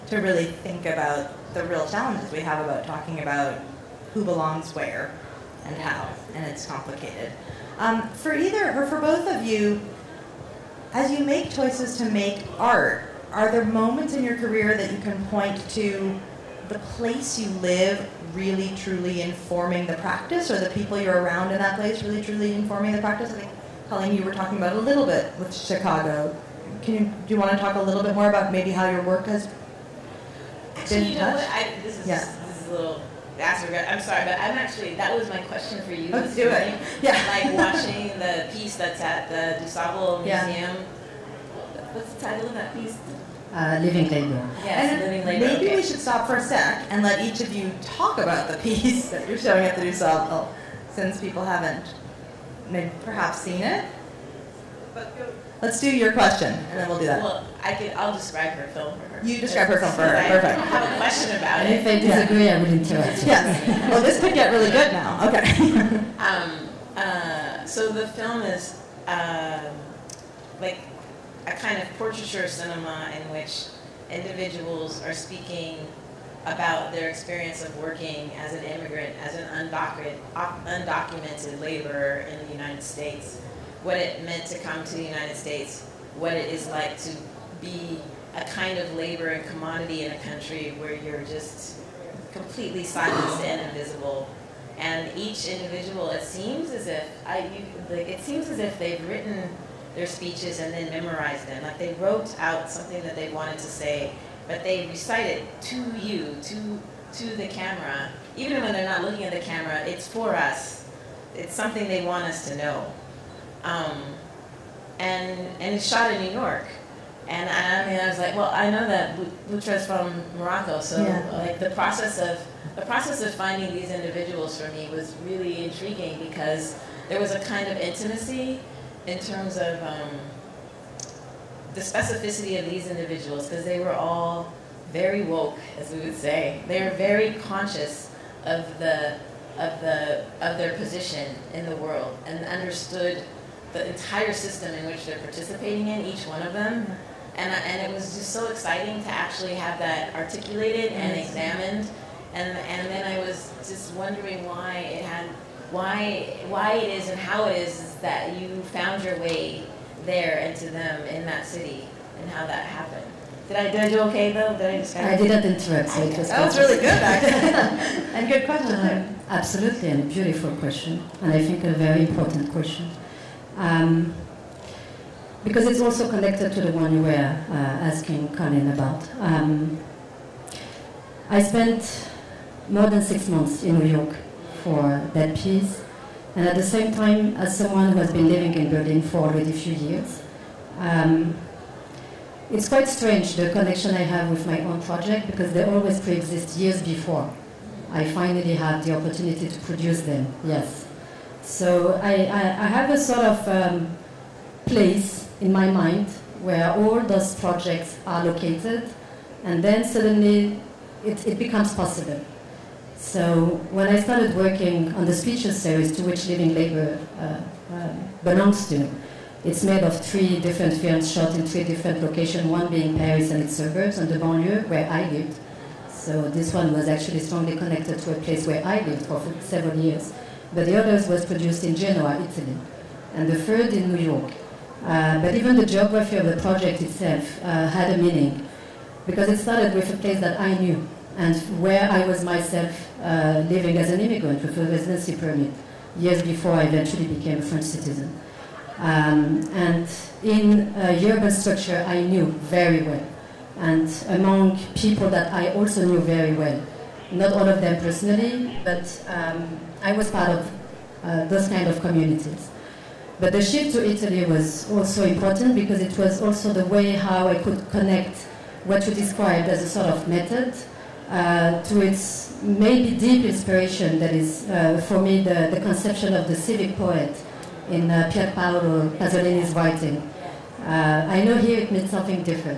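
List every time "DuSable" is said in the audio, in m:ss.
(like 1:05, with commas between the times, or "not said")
0:39, 0:49.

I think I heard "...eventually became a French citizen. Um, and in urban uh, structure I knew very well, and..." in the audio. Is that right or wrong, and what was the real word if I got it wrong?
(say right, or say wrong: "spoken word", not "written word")
right.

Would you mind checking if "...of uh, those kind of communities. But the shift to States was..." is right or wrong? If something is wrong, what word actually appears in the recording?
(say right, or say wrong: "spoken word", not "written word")
wrong: "Italy", not "States".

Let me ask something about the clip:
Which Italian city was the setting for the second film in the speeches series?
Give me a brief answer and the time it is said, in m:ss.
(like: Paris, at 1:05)
Genoa, at 3:51.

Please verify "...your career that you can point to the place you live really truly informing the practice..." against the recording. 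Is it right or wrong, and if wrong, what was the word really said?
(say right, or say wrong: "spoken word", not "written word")
right.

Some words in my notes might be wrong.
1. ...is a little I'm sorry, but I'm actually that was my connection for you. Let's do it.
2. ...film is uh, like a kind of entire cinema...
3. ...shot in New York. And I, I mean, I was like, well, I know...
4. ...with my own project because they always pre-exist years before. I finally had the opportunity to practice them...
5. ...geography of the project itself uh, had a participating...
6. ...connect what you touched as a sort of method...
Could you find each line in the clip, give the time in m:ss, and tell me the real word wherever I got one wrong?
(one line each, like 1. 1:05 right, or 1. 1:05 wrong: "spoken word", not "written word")
1. 0:32 wrong: "question", not "connection"
2. 1:08 wrong: "portraiture", not "entire"
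3. 1:55 right
4. 3:14 wrong: "produce", not "practice"
5. 3:55 wrong: "meaning", not "participating"
6. 4:27 wrong: "described", not "touched".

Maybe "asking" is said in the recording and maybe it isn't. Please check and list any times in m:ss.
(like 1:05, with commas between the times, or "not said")
2:57.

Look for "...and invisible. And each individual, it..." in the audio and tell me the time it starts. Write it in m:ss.
1:33.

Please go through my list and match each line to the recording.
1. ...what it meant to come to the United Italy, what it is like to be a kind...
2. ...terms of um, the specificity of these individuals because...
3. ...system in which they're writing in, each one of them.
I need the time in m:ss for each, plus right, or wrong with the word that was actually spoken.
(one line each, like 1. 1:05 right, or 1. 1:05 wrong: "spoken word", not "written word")
1. 1:23 wrong: "States", not "Italy"
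2. 2:09 right
3. 2:24 wrong: "participating", not "writing".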